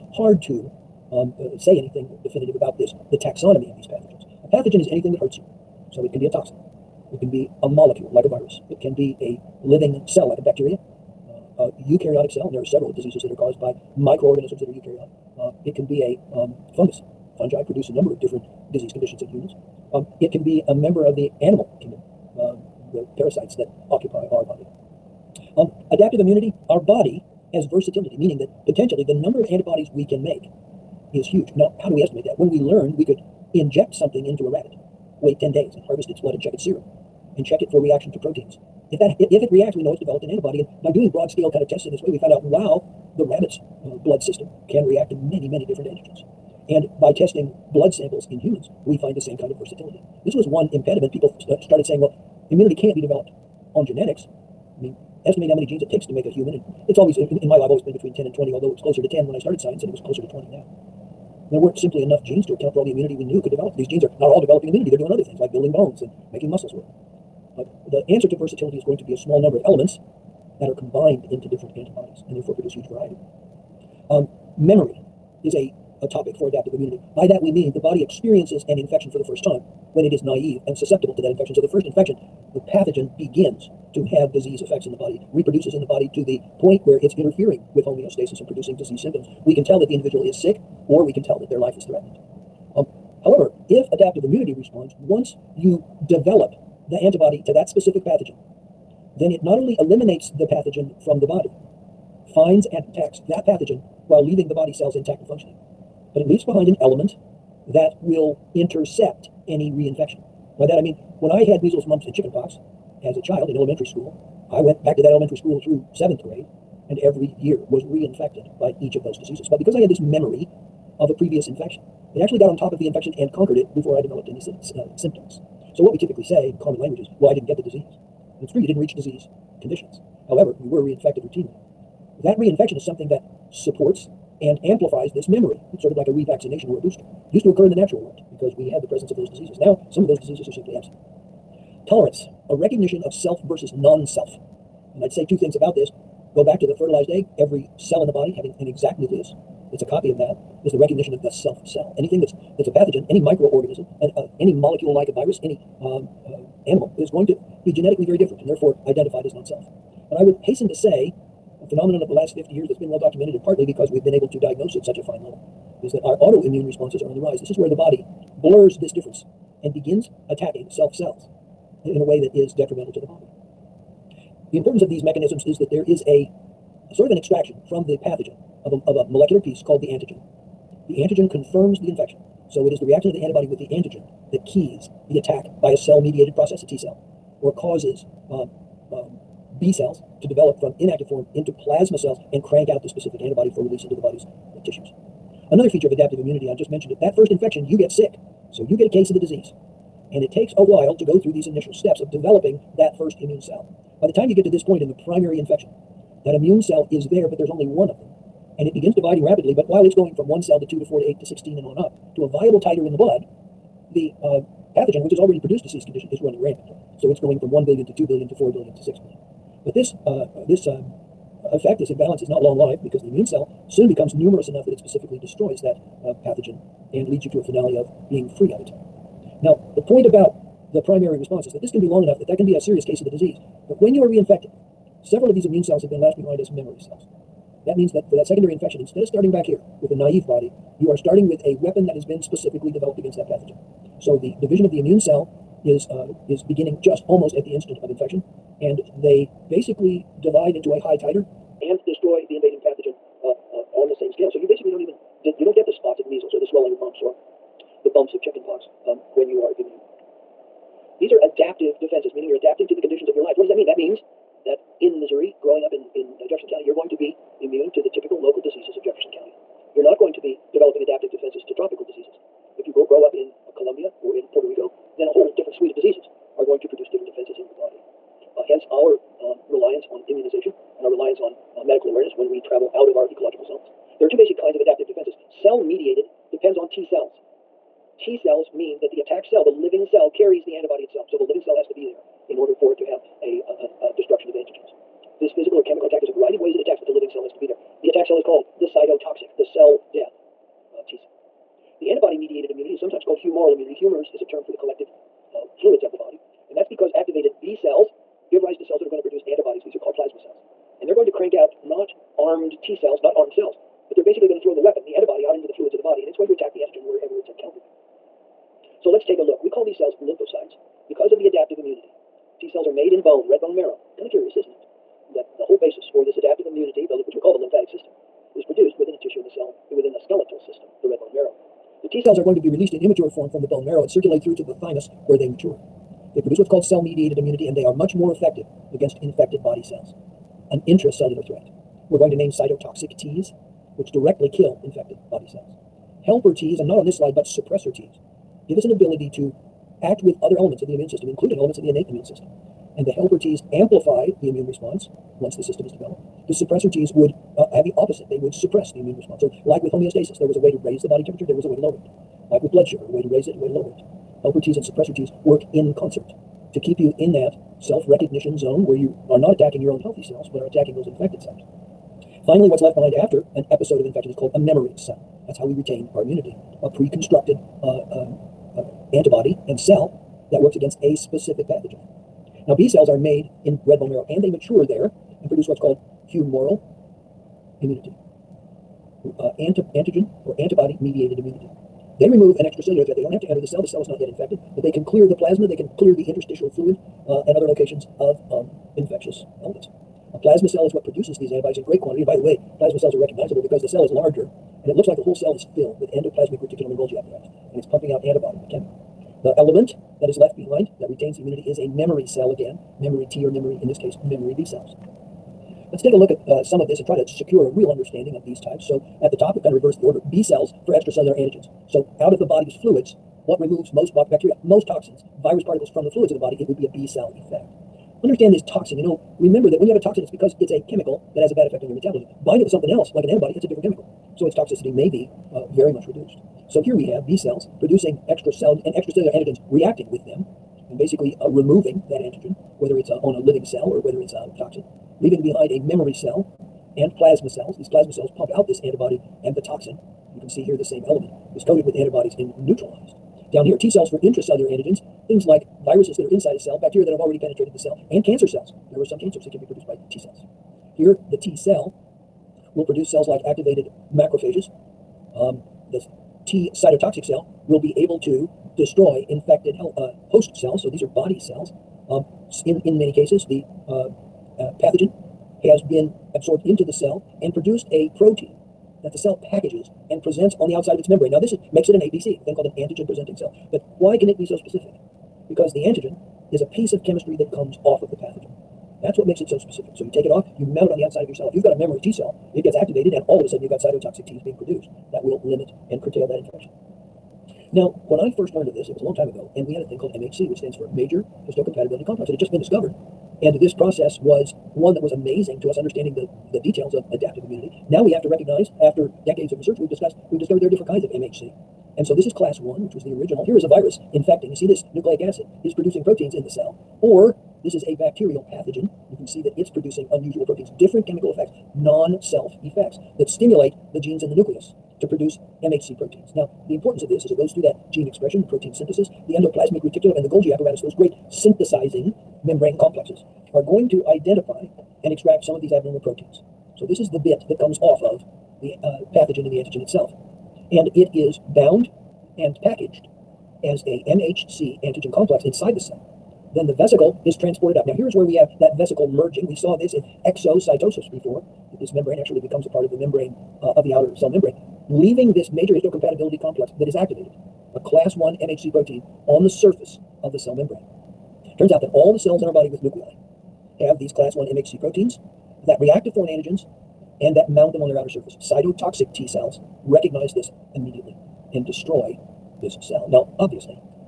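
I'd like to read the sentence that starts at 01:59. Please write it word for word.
But because I had this memory of a previous infection.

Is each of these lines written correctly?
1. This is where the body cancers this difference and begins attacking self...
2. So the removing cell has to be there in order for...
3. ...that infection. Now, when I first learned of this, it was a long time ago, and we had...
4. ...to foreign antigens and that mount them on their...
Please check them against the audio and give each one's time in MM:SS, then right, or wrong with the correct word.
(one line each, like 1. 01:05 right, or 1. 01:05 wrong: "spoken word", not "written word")
1. 02:47 wrong: "blurs", not "cancers"
2. 04:51 wrong: "living", not "removing"
3. 08:16 right
4. 09:25 right.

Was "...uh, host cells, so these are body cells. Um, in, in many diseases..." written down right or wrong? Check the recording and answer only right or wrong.
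wrong.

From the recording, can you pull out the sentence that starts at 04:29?
You're not going to be developing adaptive defenses to tropical diseases.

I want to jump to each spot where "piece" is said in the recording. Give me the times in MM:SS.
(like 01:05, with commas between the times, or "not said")
02:59, 08:06.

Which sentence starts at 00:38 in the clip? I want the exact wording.
If that if, if it reacts, we know it's developed an antibody.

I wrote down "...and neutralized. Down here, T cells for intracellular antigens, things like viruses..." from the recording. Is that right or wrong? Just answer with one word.
right.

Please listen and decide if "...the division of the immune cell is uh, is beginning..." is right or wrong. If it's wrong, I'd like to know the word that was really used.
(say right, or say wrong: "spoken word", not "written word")
right.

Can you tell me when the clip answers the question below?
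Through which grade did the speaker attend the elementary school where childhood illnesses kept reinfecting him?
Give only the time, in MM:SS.
01:55.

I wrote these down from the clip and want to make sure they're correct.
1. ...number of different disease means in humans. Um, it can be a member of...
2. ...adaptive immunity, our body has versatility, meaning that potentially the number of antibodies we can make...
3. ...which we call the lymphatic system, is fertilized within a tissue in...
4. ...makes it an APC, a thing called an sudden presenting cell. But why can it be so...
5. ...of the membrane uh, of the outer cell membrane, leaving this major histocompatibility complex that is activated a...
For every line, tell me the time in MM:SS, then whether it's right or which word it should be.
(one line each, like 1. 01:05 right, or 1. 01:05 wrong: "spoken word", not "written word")
1. 00:17 wrong: "conditions", not "means"
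2. 00:25 right
3. 05:27 wrong: "produced", not "fertilized"
4. 08:01 wrong: "antigen", not "sudden"
5. 09:12 right.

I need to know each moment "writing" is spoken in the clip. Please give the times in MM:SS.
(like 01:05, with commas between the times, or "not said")
not said.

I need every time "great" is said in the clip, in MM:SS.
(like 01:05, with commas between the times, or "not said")
06:41, 08:50.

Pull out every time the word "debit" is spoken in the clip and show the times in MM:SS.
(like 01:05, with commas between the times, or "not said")
not said.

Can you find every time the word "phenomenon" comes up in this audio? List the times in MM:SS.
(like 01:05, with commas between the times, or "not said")
02:41.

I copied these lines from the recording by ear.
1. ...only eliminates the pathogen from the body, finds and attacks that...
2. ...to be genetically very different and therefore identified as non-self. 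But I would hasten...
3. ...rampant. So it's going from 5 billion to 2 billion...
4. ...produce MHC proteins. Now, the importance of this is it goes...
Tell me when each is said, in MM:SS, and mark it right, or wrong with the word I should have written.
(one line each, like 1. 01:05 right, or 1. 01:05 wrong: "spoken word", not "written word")
1. 01:39 right
2. 02:37 right
3. 03:36 wrong: "1", not "5"
4. 08:44 right.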